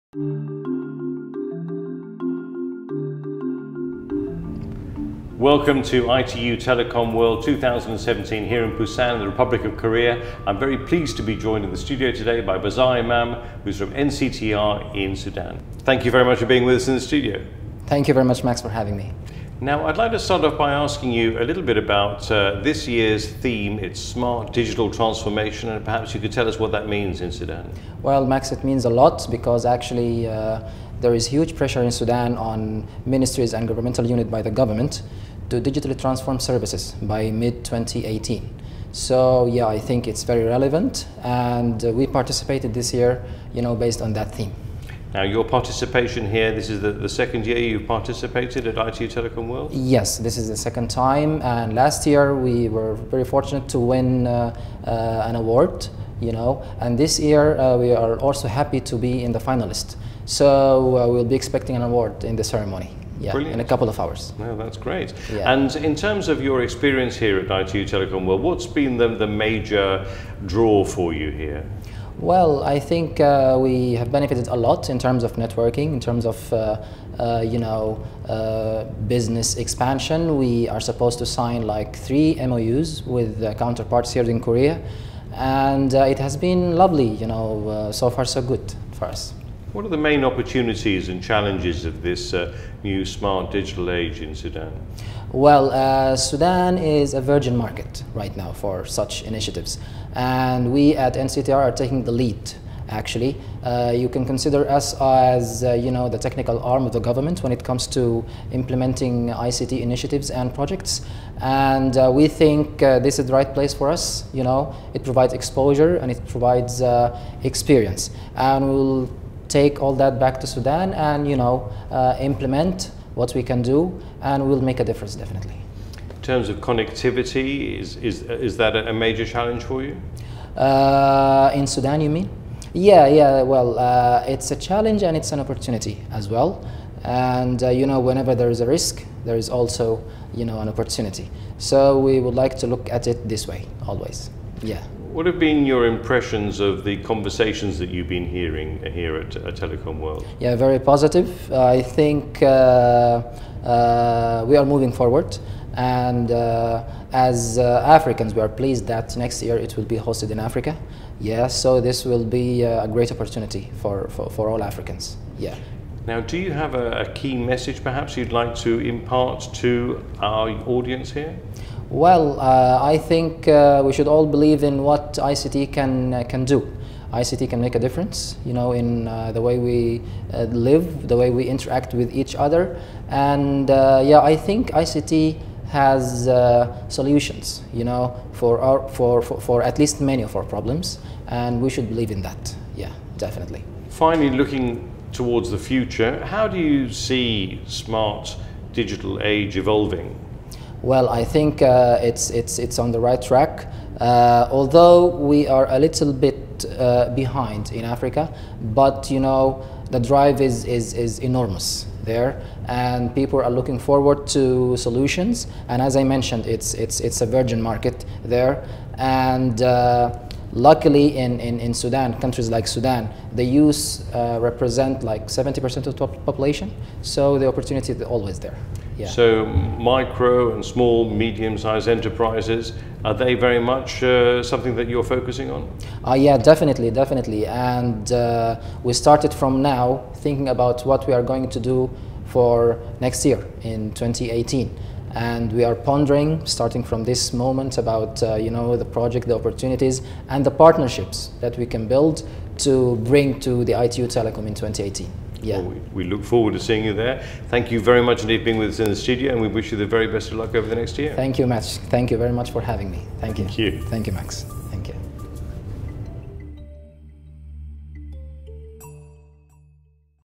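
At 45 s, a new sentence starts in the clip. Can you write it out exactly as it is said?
Now, your participation here, this is the, the second year you've participated at ITU Telecom World?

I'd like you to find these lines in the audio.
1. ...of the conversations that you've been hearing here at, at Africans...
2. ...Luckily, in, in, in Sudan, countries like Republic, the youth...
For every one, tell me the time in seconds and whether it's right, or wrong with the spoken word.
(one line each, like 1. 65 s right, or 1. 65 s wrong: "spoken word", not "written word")
1. 146 s wrong: "Telecom", not "Africans"
2. 220 s wrong: "Sudan", not "Republic".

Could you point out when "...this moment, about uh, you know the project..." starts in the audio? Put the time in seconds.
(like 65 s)
247 s.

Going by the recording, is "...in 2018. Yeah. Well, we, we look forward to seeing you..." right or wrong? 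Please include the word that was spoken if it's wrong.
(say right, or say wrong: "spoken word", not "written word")
right.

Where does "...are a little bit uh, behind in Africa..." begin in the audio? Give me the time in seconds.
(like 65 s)
205 s.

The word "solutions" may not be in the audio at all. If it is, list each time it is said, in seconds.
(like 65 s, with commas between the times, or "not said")
186 s, 214 s.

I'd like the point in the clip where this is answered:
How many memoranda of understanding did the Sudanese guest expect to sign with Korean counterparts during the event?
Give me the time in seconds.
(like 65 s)
81 s.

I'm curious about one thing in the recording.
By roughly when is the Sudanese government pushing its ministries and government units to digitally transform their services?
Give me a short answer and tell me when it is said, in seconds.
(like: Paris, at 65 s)
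mid 2018, at 37 s.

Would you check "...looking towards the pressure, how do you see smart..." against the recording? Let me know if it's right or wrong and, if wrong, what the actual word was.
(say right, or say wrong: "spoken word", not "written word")
wrong: "future", not "pressure".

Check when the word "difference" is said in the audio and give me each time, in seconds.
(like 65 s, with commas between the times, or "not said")
124 s, 177 s.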